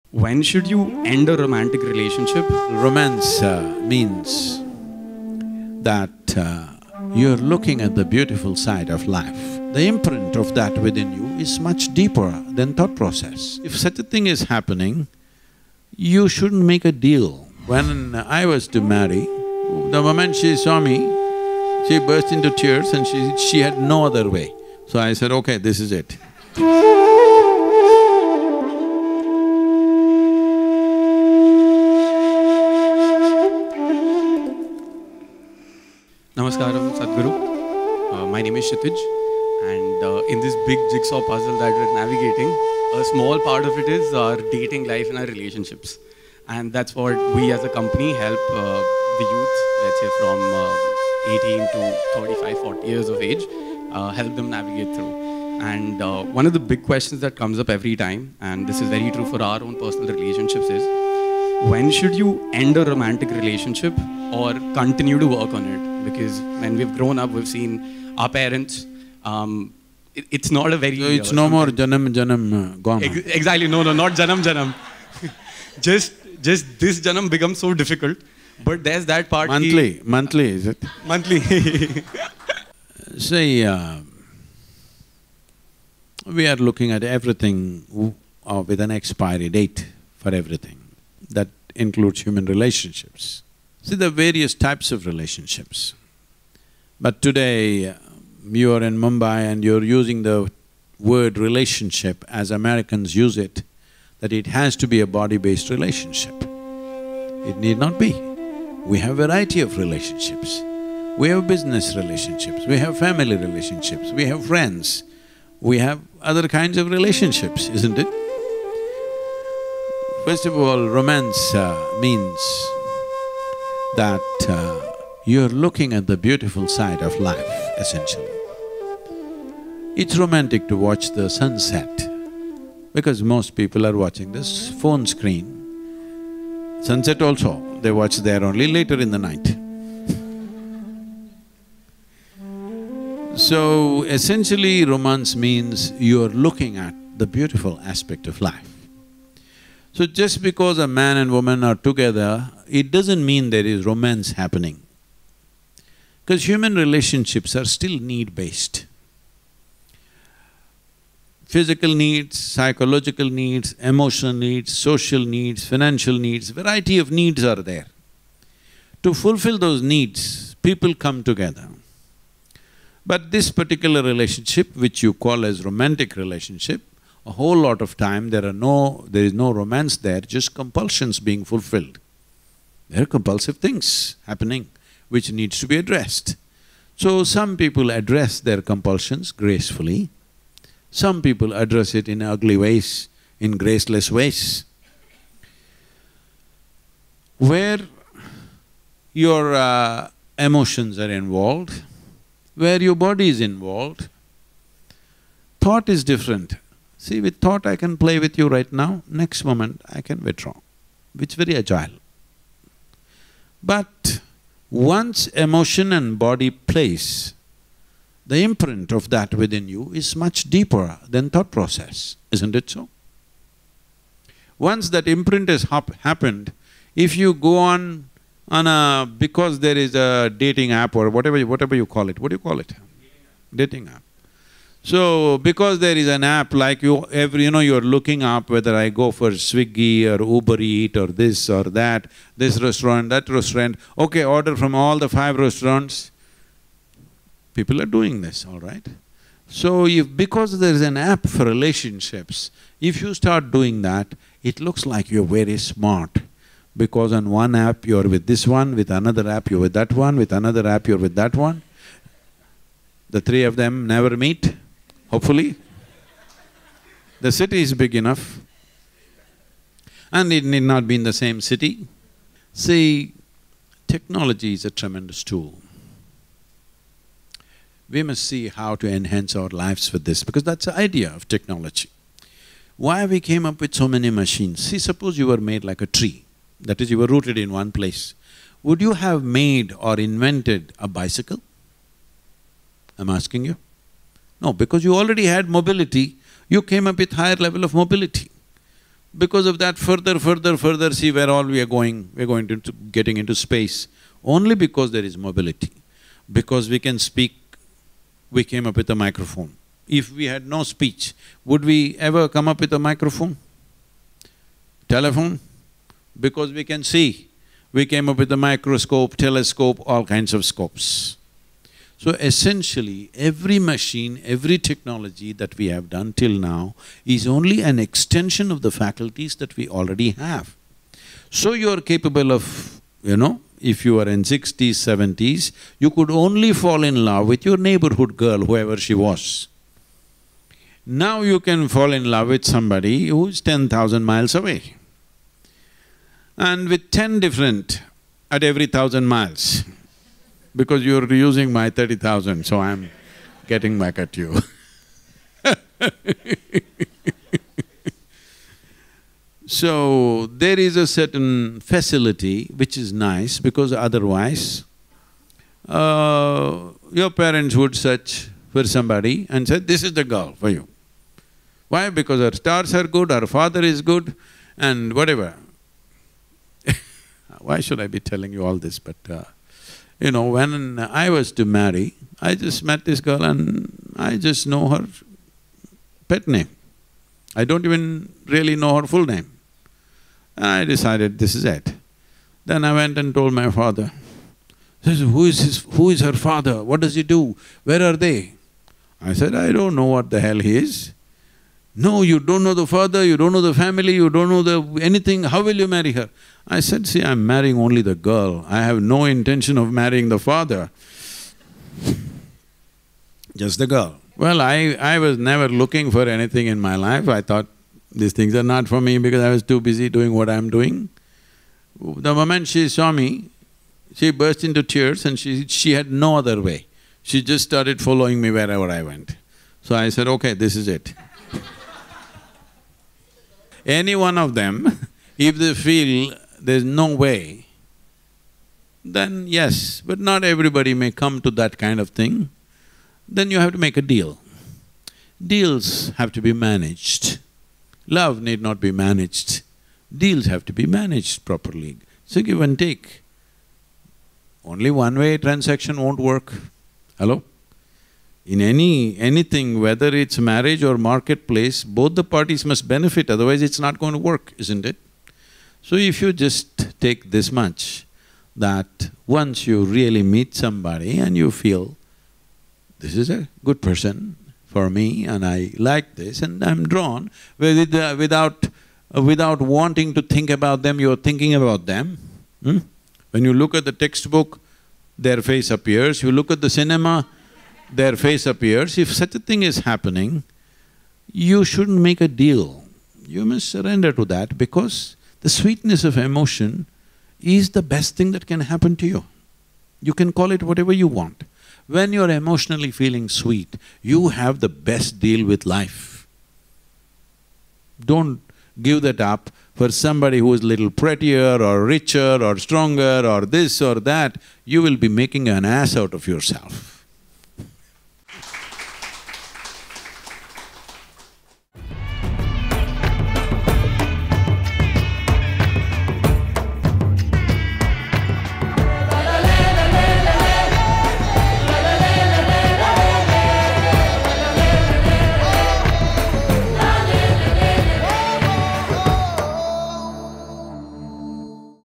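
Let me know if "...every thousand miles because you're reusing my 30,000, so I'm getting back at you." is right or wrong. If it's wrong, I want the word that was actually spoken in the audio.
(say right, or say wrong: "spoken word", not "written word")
right.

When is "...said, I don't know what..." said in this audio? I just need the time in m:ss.
6:39.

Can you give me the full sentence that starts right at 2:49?
To fulfill those needs, people come together.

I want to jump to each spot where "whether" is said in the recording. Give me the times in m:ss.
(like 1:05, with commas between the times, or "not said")
3:58, 7:39.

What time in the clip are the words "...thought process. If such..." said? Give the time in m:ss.
0:12.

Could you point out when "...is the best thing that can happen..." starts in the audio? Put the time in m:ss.
8:17.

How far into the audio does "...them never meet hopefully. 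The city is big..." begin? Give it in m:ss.
4:23.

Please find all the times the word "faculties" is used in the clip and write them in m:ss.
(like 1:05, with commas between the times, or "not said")
5:28.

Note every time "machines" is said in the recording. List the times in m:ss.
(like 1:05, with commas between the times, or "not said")
4:44, 5:23.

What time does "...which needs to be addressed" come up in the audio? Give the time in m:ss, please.
3:05.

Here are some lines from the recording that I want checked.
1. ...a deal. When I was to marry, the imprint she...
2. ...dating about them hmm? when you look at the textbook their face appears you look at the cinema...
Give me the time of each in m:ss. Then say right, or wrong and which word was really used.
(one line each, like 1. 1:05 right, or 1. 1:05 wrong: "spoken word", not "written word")
1. 0:16 wrong: "moment", not "imprint"
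2. 8:00 wrong: "thinking", not "dating".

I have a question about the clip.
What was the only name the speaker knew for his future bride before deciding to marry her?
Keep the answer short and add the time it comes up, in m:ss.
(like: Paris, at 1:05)
Her pet name, at 6:26.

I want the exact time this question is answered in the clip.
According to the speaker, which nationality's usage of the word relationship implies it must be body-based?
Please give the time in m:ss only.
1:42.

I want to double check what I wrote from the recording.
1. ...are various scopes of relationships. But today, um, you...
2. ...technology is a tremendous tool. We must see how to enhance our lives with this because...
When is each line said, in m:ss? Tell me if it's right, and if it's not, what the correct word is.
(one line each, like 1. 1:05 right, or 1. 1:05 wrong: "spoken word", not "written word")
1. 1:34 wrong: "types", not "scopes"
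2. 4:33 right.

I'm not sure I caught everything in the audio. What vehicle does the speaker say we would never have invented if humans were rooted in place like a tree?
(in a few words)
Bicycle.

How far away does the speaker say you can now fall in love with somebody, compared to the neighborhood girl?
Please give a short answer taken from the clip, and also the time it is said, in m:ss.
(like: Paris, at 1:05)
10,000 miles, at 5:43.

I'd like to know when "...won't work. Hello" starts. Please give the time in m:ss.
7:35.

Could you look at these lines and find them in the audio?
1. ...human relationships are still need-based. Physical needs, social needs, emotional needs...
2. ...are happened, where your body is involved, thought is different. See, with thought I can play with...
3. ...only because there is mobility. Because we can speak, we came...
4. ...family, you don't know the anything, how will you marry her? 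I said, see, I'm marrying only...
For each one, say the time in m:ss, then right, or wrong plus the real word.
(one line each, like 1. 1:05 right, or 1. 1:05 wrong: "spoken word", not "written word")
1. 2:36 wrong: "psychological", not "social"
2. 3:20 wrong: "involved", not "happened"
3. 5:04 right
4. 6:43 right.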